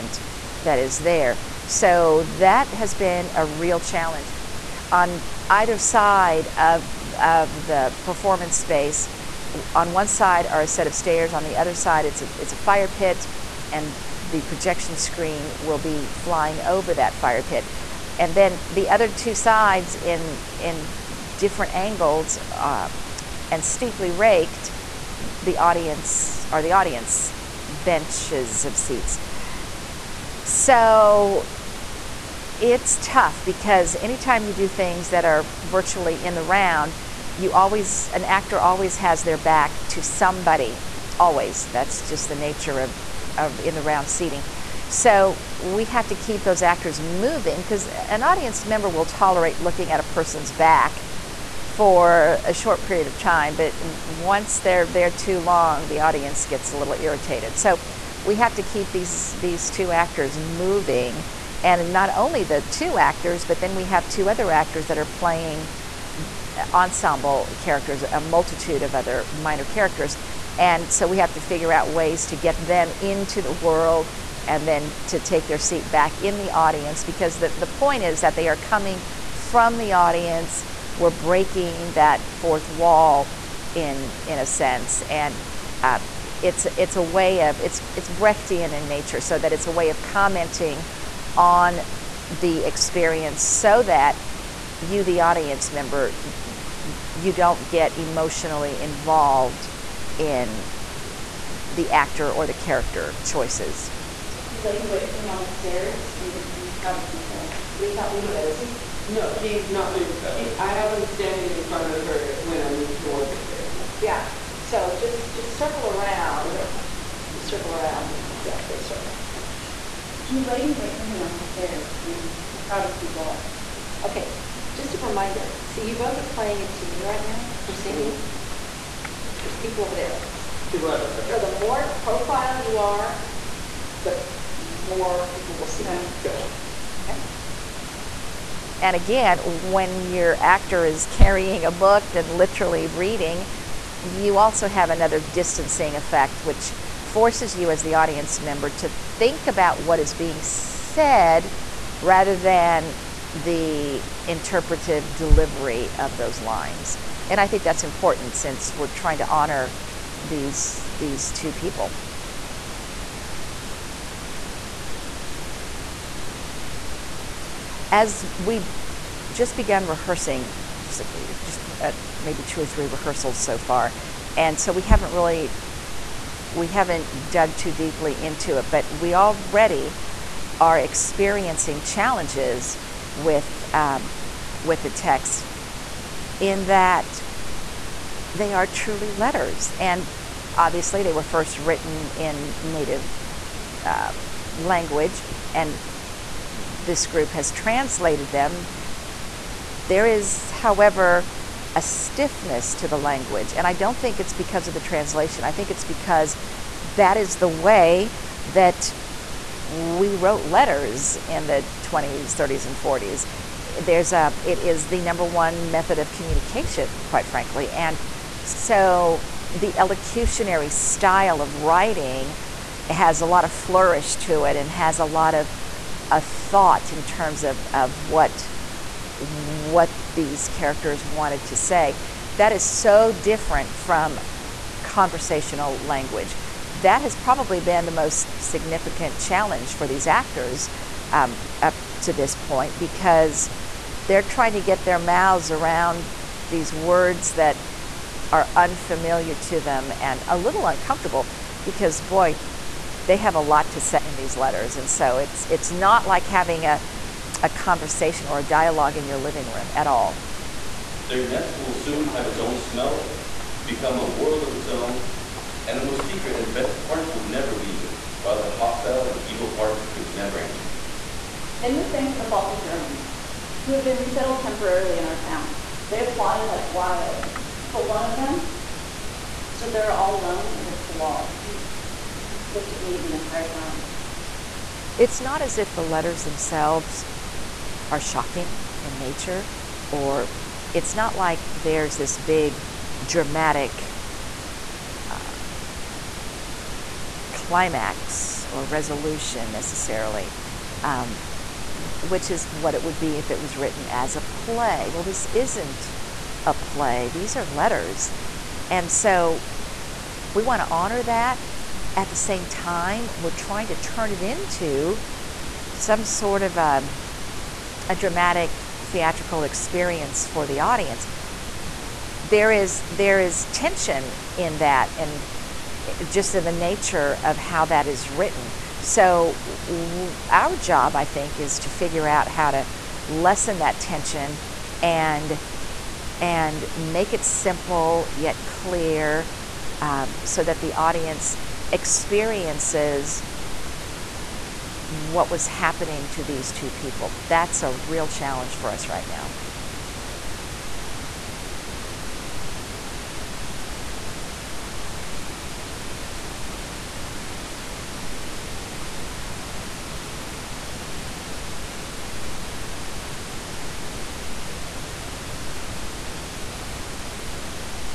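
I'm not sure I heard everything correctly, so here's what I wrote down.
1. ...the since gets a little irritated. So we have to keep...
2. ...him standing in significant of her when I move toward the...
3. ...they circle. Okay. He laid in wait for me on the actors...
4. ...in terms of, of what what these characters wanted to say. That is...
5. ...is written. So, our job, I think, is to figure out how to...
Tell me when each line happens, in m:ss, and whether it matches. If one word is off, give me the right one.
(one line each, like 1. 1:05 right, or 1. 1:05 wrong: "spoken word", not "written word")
1. 0:55 wrong: "audience", not "since"
2. 1:50 wrong: "front", not "significant"
3. 1:58 wrong: "stairs", not "actors"
4. 3:46 right
5. 5:27 right.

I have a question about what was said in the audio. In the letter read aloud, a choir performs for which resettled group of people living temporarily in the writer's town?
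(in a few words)
Baltic Germans.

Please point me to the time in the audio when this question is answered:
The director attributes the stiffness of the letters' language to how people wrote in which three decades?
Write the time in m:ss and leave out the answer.
3:31.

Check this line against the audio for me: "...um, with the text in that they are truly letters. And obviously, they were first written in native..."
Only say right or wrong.
right.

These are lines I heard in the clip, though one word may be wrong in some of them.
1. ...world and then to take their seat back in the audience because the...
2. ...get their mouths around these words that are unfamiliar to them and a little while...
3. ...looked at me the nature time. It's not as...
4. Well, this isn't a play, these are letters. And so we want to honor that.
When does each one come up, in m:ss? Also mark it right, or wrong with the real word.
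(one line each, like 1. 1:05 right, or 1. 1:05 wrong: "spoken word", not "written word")
1. 1:13 right
2. 4:04 wrong: "uncomfortable", not "while"
3. 4:42 wrong: "entire", not "nature"
4. 5:04 right.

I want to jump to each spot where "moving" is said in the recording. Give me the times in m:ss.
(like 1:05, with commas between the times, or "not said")
0:46, 1:00.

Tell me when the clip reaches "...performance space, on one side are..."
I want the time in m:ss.
0:08.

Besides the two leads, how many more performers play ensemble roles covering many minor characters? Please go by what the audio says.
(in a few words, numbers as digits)
2.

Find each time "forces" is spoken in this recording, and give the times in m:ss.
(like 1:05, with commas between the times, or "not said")
2:27.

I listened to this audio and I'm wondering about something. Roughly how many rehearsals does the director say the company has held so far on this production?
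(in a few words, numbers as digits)
2 or 3.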